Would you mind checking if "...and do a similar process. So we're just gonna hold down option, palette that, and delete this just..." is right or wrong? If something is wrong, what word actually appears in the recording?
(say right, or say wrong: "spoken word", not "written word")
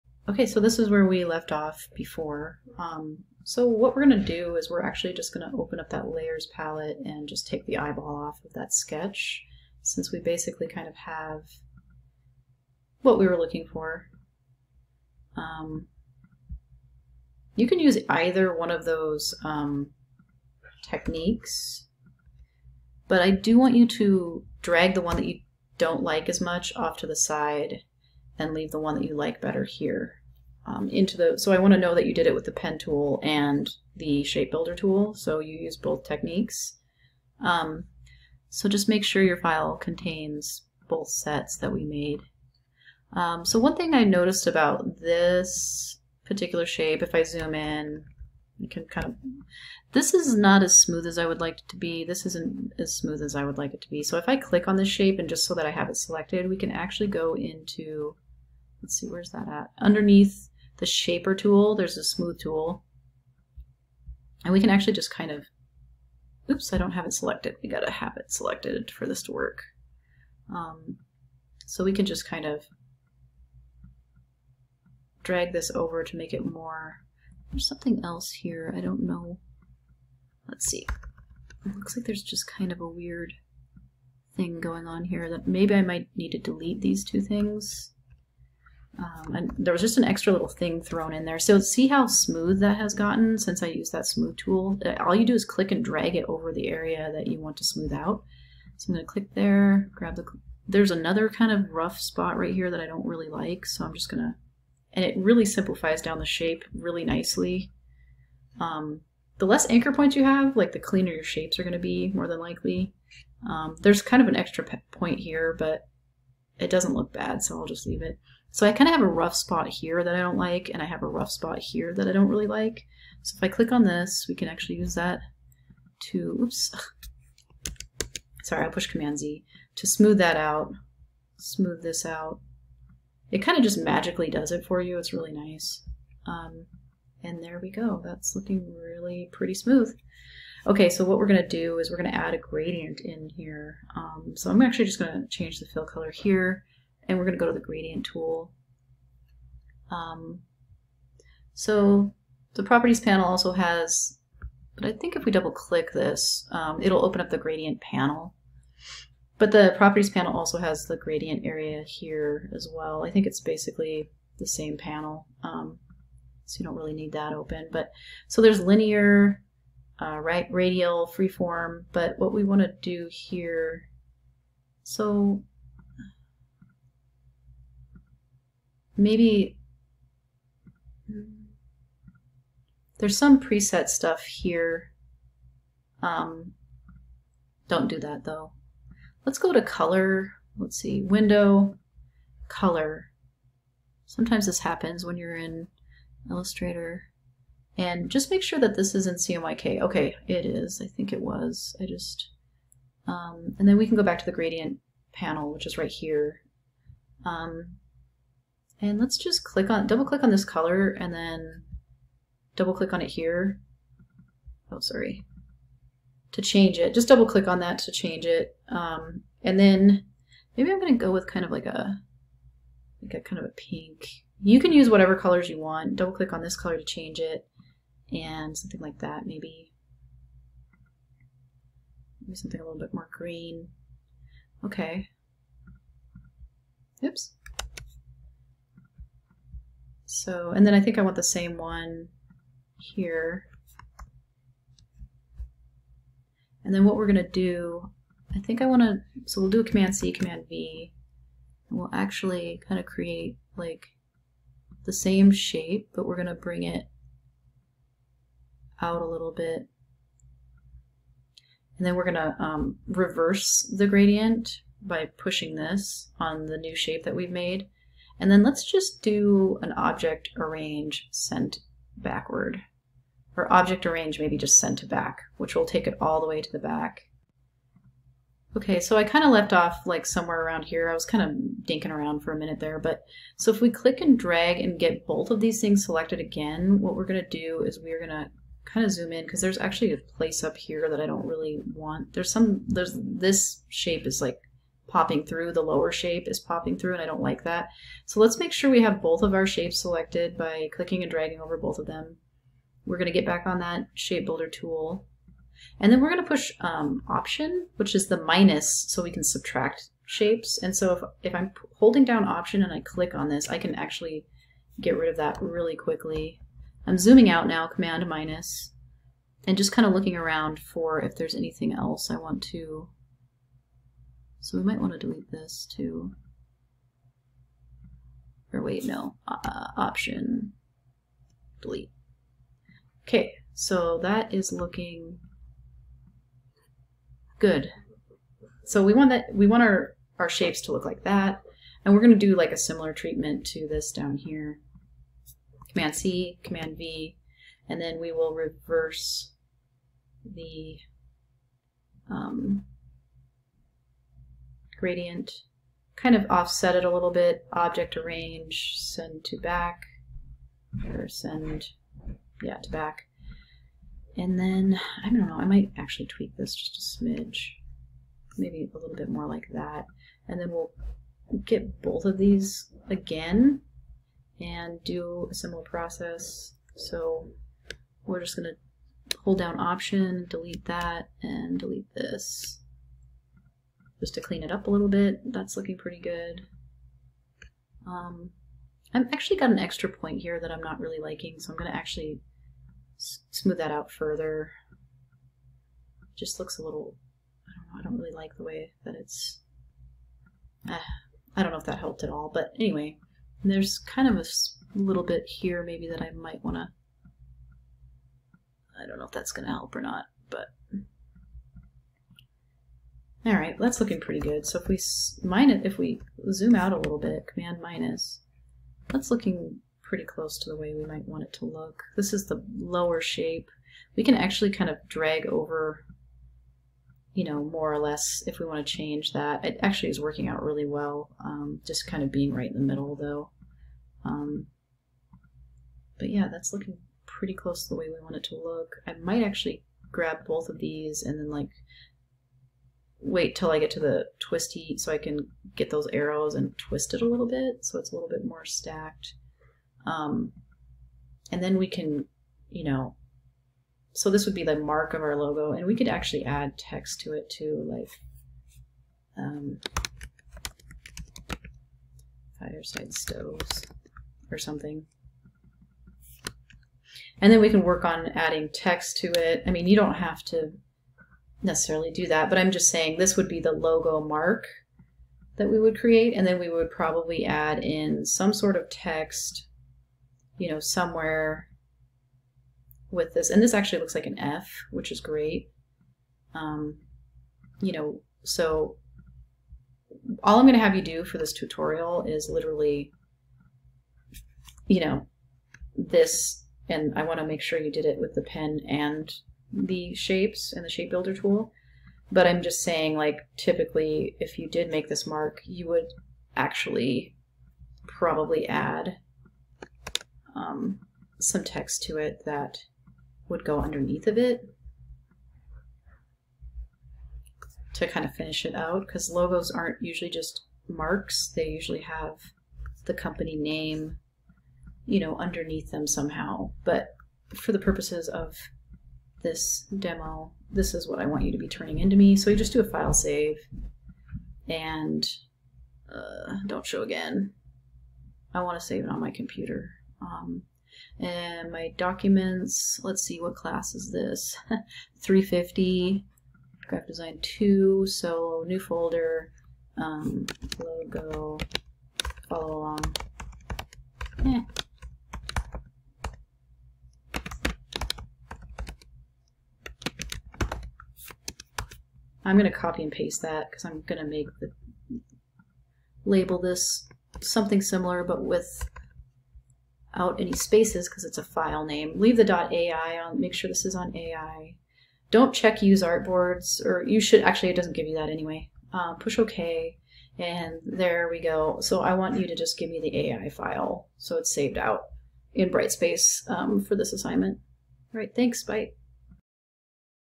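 wrong: "delete", not "palette".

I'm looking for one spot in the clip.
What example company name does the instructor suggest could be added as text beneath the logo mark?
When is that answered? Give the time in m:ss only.
7:42.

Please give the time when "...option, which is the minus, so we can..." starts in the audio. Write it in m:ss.
5:07.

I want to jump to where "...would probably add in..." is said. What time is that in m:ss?
7:56.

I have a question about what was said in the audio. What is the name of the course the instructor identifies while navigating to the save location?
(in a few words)
Graphic Design 2.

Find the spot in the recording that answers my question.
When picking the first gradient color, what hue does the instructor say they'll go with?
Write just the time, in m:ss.
3:43.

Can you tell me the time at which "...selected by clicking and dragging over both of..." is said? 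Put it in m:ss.
4:59.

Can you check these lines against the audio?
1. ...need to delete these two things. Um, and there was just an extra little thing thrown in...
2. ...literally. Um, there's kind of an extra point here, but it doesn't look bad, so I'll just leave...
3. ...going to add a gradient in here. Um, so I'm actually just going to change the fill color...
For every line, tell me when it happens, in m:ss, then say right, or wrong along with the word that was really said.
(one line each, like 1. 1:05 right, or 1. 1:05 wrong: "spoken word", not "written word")
1. 1:26 right
2. 1:52 wrong: "likely", not "literally"
3. 2:22 right.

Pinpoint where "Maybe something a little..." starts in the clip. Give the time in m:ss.
3:52.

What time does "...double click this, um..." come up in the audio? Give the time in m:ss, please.
2:35.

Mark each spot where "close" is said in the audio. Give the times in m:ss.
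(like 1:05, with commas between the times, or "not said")
7:00, 7:17.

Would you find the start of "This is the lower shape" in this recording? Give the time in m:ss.
7:01.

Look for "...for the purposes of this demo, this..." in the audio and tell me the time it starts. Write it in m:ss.
8:47.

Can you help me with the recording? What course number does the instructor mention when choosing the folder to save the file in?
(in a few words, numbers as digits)
350.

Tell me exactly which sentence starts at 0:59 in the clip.
Underneath the shaper tool, there's a smooth tool.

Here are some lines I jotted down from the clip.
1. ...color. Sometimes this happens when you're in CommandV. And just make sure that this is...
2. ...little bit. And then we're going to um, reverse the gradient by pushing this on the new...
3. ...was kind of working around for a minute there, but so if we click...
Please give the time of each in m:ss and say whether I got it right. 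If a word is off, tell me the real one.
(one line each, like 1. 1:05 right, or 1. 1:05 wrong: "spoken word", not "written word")
1. 3:12 wrong: "Illustrator", not "CommandV"
2. 4:19 right
3. 4:40 wrong: "dinking", not "working".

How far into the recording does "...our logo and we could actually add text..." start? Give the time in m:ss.
7:35.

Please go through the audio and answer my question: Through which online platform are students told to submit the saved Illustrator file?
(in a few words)
Brightspace.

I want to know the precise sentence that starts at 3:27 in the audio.
Um, and let's just click on, double click on this color and then double click on it here.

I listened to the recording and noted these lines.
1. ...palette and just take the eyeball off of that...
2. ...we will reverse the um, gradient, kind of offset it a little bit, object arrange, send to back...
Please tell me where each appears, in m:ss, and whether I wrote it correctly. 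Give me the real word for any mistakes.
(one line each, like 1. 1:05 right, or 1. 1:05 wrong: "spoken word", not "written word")
1. 0:06 right
2. 5:48 right.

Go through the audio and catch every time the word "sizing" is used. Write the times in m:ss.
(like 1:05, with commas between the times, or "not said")
not said.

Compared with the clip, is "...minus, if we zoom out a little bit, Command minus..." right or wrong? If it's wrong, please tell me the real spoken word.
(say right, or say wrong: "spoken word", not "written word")
right.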